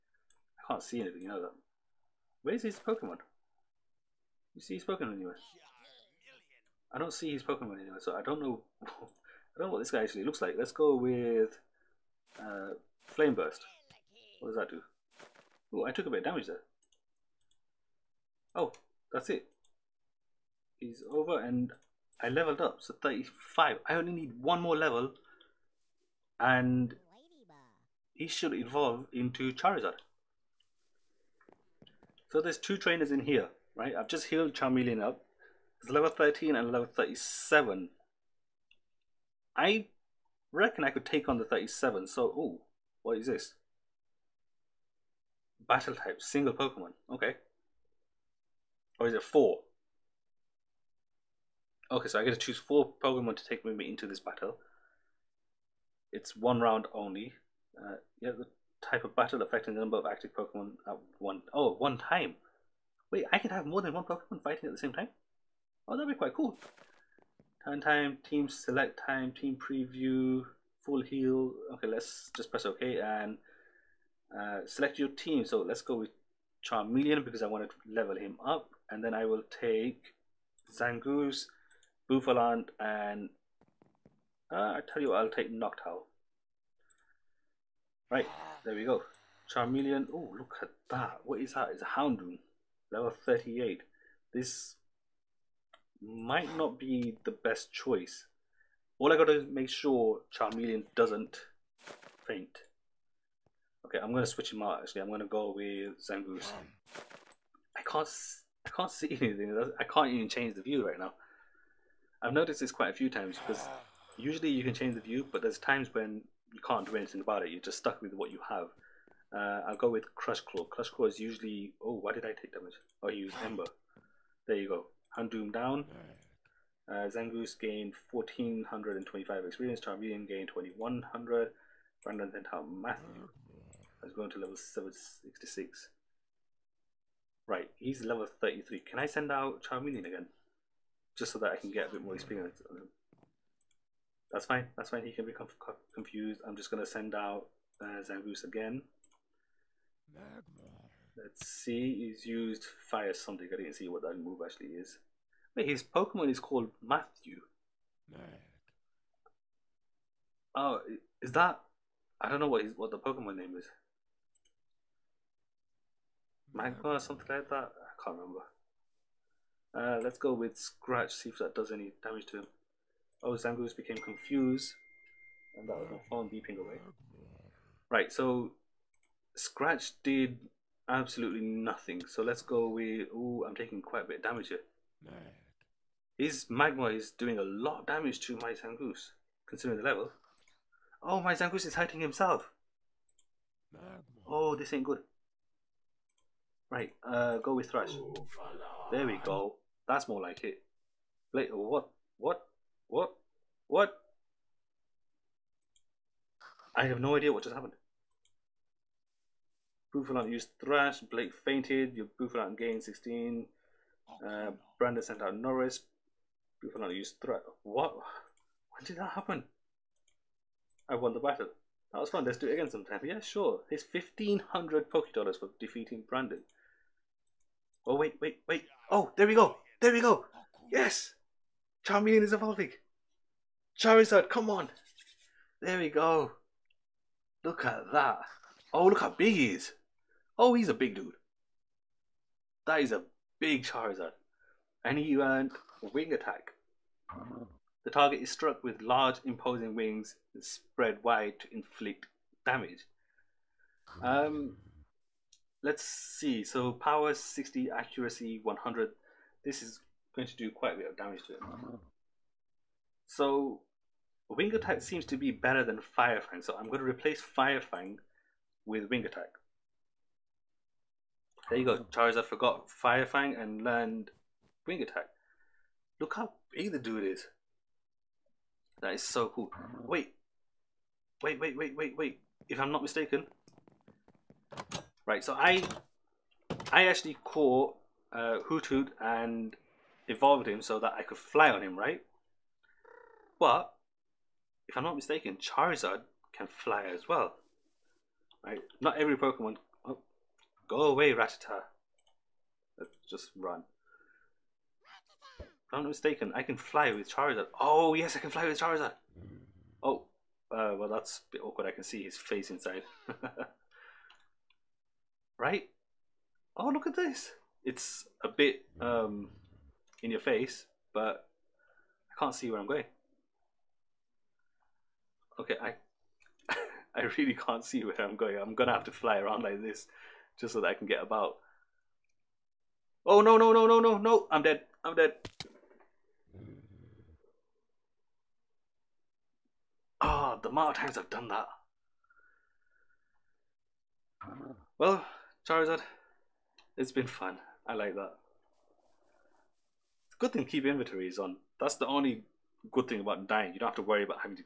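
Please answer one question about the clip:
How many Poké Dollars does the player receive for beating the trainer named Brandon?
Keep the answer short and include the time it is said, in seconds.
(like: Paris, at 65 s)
1500, at 223 s.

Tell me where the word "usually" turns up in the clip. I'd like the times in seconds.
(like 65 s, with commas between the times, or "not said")
114 s, 121 s.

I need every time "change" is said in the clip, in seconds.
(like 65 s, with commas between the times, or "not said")
110 s, 114 s.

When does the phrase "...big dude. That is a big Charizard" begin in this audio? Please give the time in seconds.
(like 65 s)
240 s.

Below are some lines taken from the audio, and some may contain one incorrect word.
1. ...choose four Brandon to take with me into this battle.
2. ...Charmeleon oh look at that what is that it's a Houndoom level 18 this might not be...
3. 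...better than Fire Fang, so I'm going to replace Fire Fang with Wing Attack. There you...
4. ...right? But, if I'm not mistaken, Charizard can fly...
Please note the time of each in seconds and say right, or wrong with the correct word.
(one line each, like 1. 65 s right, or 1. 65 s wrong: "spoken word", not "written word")
1. 52 s wrong: "Pokemon", not "Brandon"
2. 89 s wrong: "38", not "18"
3. 265 s right
4. 291 s right.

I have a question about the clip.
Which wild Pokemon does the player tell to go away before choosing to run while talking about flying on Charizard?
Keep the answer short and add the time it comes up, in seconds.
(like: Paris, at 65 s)
Rattata, at 301 s.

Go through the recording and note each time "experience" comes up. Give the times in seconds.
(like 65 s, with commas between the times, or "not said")
129 s, 142 s.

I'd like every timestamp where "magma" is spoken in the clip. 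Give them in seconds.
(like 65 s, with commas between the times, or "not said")
166 s, 186 s.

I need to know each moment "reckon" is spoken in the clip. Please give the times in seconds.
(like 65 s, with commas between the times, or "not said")
40 s.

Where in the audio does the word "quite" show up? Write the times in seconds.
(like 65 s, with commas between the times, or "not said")
66 s, 112 s, 183 s, 260 s.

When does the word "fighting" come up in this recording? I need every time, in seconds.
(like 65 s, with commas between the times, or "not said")
64 s.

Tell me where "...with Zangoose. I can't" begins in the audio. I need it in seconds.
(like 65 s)
105 s.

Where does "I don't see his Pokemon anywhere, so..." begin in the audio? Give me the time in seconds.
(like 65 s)
6 s.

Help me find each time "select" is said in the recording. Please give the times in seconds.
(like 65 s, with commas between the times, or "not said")
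68 s, 74 s.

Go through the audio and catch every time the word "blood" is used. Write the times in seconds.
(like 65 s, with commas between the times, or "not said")
not said.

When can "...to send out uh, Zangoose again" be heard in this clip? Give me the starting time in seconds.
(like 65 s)
146 s.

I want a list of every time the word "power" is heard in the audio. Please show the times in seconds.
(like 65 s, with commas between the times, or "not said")
256 s.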